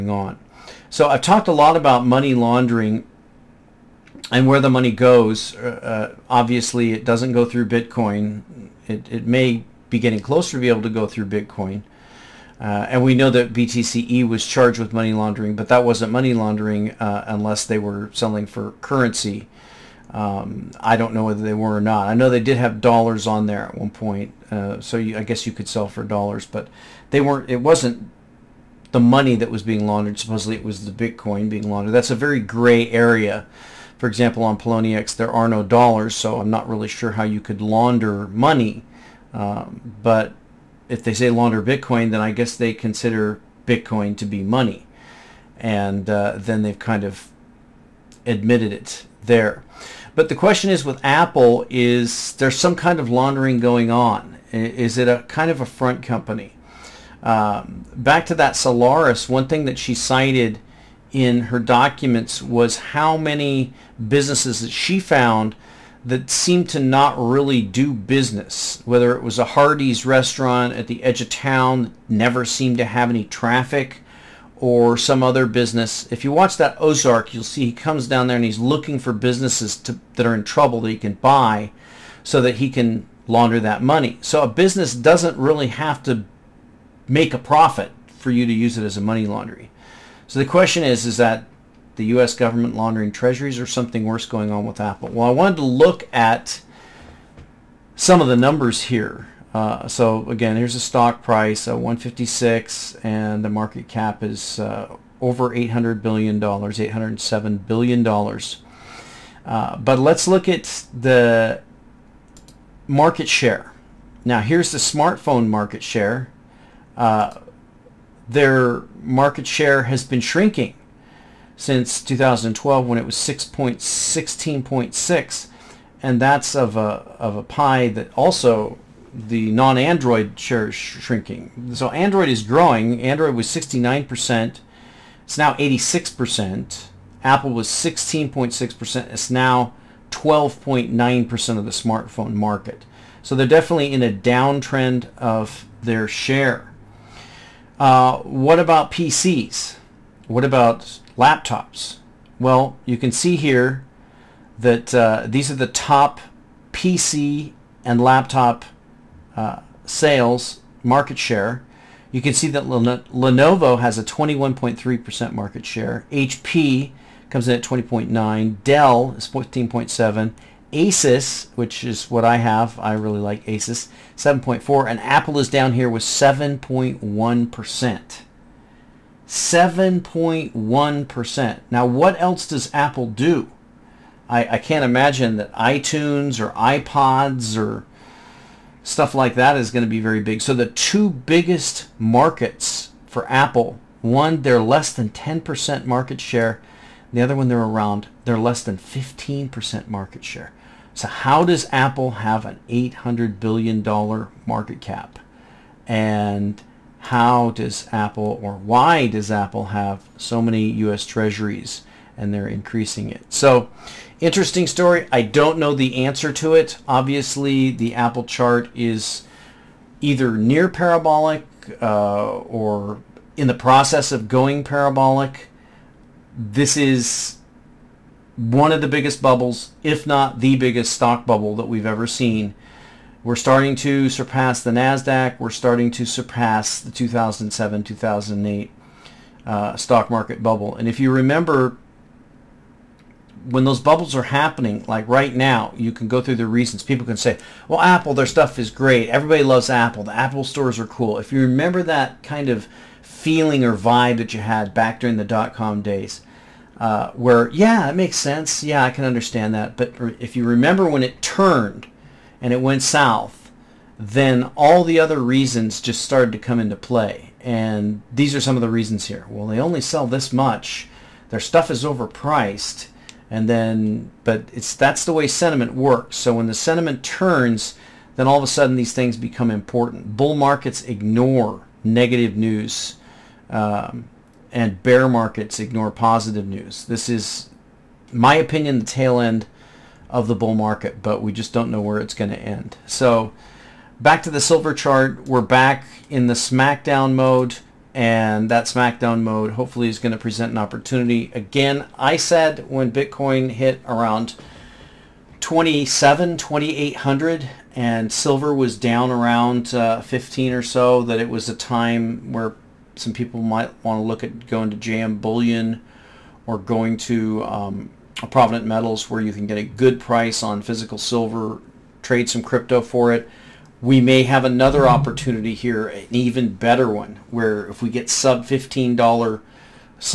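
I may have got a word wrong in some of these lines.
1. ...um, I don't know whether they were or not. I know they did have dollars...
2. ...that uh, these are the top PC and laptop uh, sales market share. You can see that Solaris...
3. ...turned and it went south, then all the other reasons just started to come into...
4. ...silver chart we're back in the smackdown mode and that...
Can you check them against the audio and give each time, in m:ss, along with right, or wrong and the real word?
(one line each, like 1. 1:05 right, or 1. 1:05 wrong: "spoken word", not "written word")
1. 0:20 right
2. 2:34 wrong: "Lenovo", not "Solaris"
3. 4:21 right
4. 4:54 right.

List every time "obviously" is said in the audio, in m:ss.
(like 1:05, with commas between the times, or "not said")
0:06, 3:36.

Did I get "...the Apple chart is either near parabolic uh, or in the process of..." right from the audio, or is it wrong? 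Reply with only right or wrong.
right.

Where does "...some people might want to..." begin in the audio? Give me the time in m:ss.
5:12.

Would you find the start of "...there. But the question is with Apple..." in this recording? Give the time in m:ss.
0:49.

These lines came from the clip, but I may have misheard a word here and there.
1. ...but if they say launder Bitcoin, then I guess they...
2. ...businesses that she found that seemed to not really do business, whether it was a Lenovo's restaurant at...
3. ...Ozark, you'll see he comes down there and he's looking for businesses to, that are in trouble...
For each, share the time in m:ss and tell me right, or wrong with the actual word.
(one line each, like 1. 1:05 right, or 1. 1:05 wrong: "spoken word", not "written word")
1. 0:40 right
2. 1:04 wrong: "Hardee", not "Lenovo"
3. 1:16 right.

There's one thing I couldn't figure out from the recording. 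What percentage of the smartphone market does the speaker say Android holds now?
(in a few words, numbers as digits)
86%.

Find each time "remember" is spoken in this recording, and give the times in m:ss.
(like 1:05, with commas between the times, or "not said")
4:01, 4:11, 4:20.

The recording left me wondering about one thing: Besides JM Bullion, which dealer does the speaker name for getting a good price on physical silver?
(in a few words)
Provident Metals.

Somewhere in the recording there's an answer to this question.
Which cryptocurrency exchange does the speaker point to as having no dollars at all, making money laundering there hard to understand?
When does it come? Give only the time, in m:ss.
0:34.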